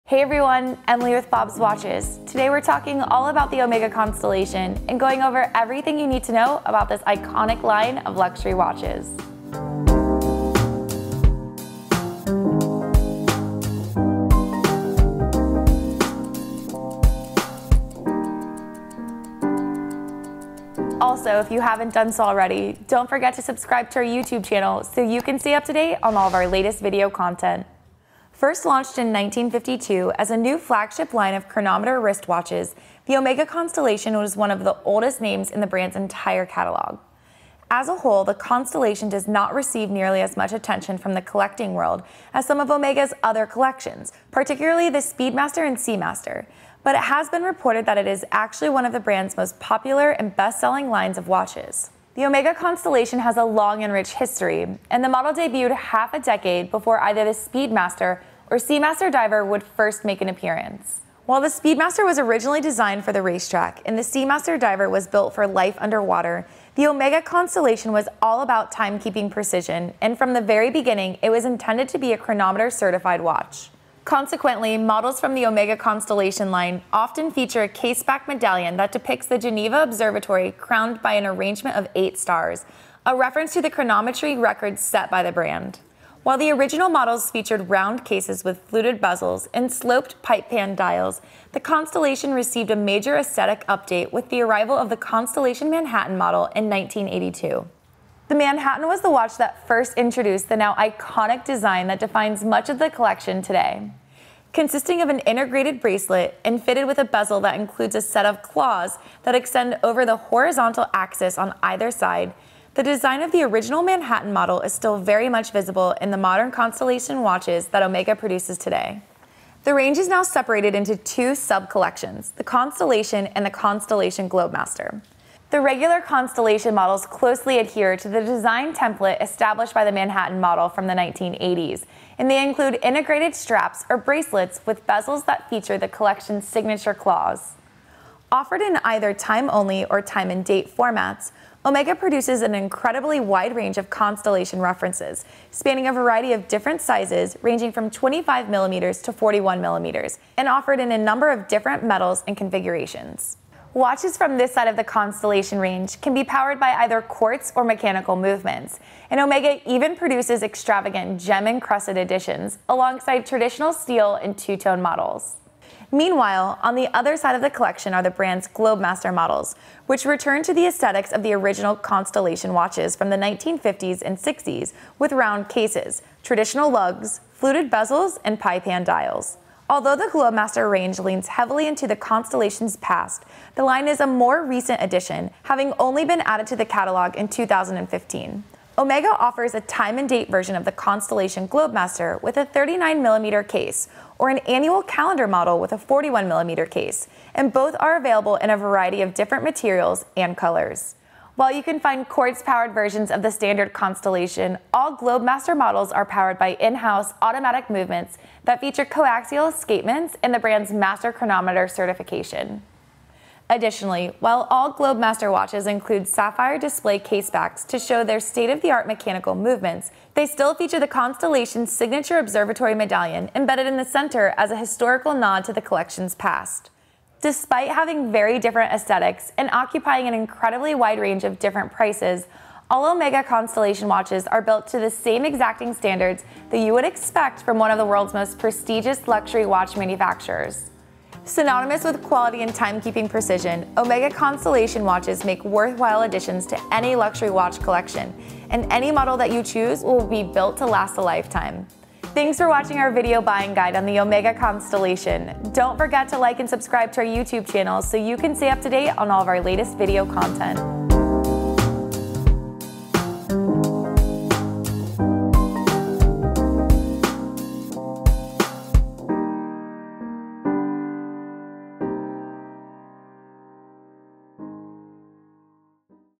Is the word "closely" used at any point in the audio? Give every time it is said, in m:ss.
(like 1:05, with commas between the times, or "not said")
2:07.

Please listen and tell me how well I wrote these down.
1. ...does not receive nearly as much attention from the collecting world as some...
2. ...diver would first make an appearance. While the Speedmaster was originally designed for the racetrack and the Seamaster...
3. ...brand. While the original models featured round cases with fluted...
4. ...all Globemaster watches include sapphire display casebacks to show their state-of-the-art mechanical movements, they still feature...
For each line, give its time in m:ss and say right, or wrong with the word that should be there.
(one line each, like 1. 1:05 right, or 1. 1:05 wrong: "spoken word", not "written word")
1. 0:39 right
2. 0:59 right
3. 1:25 right
4. 3:34 right.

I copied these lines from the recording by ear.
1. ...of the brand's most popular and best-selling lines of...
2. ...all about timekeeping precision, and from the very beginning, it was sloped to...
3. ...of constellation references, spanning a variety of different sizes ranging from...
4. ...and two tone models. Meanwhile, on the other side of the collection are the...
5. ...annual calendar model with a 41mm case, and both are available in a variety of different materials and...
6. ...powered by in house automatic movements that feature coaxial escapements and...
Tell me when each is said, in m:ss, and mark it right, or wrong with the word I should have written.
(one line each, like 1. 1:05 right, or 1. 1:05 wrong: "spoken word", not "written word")
1. 0:48 right
2. 1:08 wrong: "intended", not "sloped"
3. 2:23 right
4. 2:44 right
5. 3:14 right
6. 3:26 right.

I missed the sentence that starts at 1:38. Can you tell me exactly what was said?
The Manhattan was the watch that first introduced the now iconic design that defines much of the collection today.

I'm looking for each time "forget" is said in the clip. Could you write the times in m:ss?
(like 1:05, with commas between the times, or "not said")
0:23, 4:15.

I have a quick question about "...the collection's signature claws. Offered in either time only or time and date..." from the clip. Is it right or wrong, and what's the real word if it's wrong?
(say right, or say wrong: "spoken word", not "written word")
right.